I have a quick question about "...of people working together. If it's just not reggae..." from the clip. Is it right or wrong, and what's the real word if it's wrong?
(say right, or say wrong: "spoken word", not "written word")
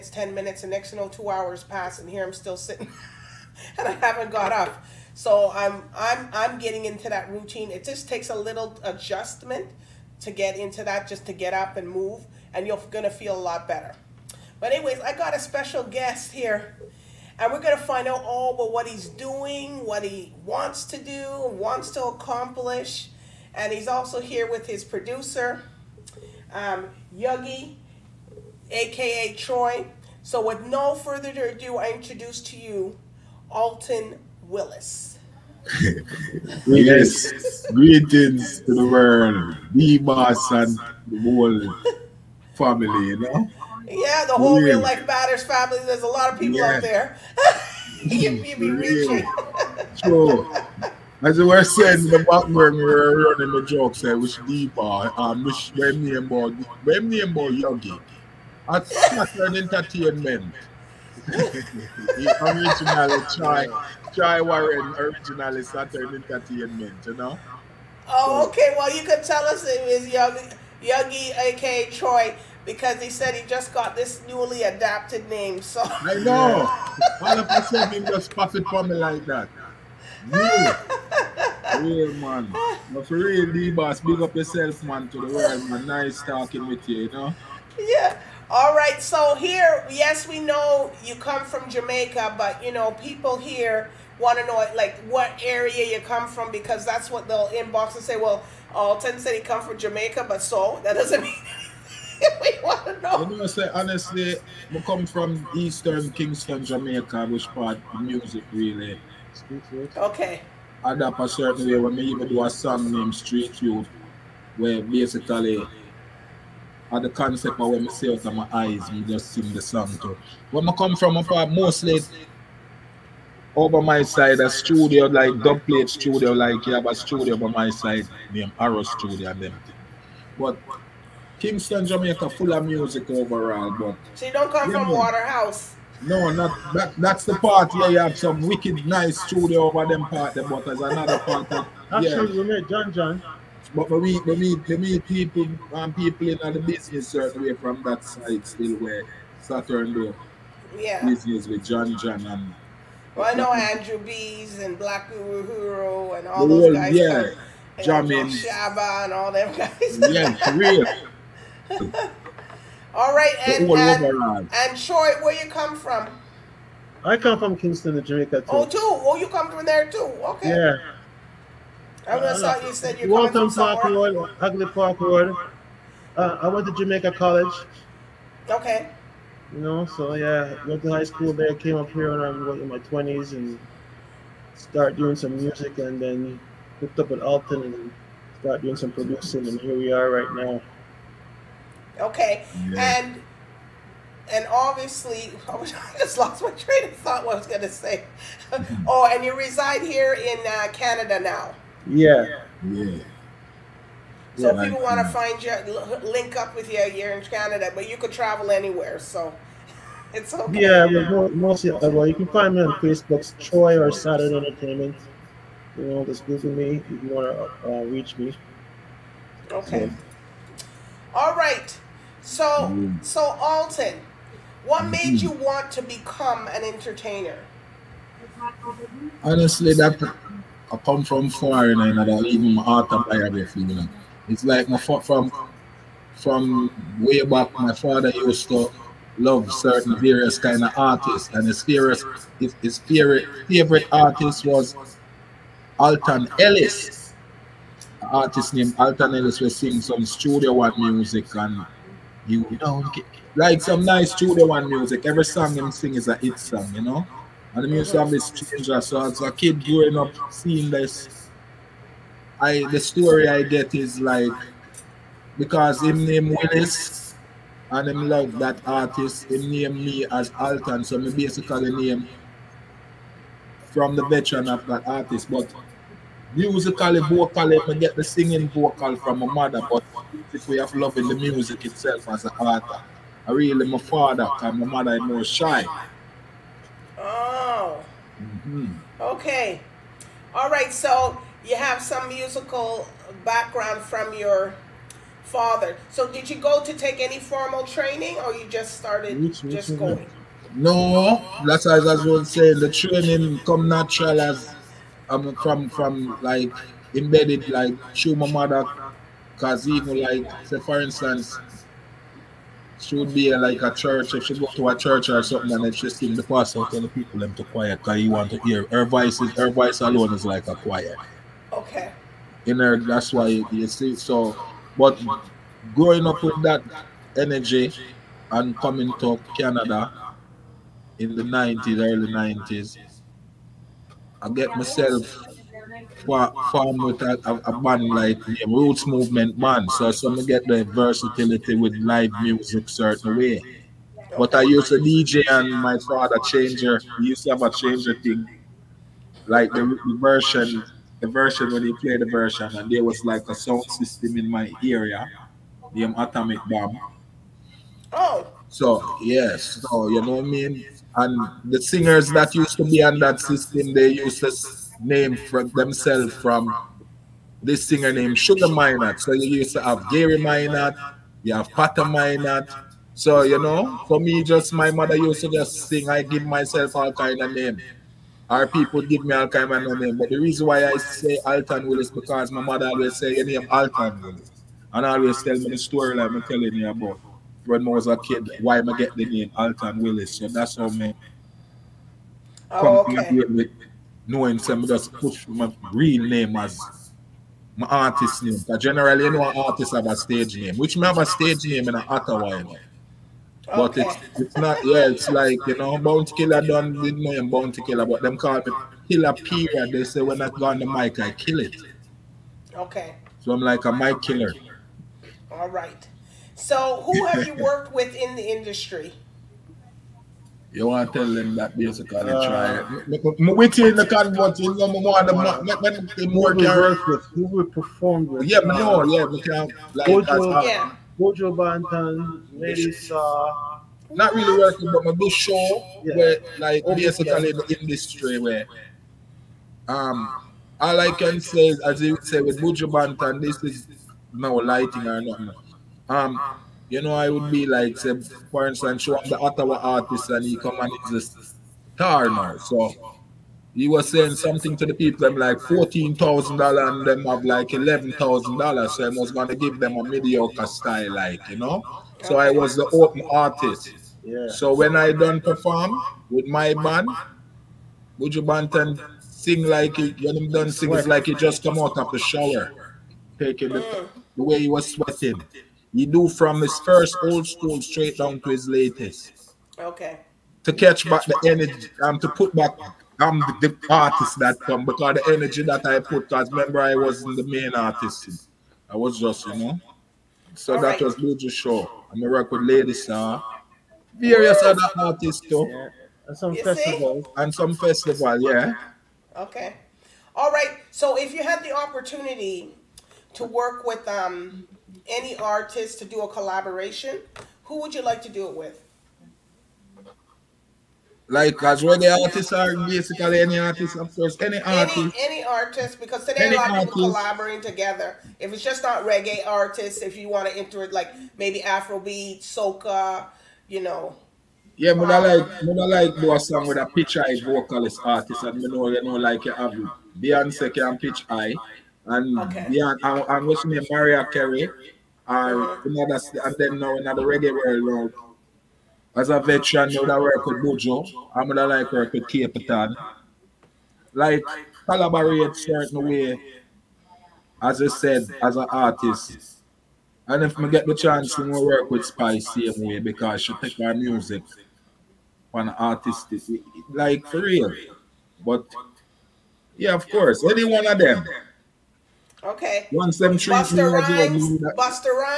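wrong: "collaborating", not "working".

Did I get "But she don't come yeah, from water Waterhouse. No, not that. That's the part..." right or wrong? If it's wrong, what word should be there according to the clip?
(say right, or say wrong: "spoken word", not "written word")
right.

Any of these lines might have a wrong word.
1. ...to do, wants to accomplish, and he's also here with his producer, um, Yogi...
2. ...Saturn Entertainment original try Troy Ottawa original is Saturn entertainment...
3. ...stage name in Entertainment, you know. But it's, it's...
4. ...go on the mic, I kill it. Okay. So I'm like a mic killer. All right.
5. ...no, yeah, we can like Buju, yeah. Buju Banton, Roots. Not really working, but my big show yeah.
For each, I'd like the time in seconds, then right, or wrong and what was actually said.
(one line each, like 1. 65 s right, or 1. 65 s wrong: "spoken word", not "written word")
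1. 20 s right
2. 58 s wrong: "Warren", not "Ottawa"
3. 401 s wrong: "Ottawa", not "Entertainment"
4. 410 s right
5. 428 s wrong: "Melissa", not "Roots".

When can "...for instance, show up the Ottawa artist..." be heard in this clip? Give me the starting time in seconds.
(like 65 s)
448 s.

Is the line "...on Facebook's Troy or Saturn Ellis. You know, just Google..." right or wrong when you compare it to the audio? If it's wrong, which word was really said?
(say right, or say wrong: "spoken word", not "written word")
wrong: "Entertainment", not "Ellis".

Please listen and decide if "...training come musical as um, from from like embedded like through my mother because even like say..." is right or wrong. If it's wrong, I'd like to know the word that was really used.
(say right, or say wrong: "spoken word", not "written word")
wrong: "natural", not "musical".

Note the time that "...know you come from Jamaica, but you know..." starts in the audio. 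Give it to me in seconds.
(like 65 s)
90 s.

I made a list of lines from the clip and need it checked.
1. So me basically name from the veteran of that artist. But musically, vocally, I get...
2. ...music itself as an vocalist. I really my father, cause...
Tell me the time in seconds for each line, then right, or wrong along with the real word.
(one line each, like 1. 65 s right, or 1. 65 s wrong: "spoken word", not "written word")
1. 270 s right
2. 281 s wrong: "artist", not "vocalist".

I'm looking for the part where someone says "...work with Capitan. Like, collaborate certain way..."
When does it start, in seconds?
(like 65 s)
541 s.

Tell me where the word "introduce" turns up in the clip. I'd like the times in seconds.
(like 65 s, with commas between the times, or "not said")
31 s.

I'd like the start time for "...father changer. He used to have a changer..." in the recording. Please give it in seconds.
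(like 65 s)
345 s.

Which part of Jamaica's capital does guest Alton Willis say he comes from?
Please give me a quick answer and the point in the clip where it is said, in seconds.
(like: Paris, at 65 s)
Eastern Kingston, at 105 s.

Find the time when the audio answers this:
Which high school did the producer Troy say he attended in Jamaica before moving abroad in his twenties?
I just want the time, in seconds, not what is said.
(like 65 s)
176 s.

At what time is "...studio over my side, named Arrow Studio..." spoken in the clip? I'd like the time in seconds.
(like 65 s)
126 s.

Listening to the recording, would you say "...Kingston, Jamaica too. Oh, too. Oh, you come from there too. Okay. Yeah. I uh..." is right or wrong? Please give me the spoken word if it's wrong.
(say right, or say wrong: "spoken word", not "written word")
right.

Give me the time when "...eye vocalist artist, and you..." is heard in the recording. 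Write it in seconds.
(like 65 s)
526 s.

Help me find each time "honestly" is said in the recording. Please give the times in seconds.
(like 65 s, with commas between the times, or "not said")
103 s, 229 s.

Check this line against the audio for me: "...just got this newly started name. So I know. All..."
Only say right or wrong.
wrong.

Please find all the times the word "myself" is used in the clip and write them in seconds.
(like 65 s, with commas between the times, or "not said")
334 s, 376 s.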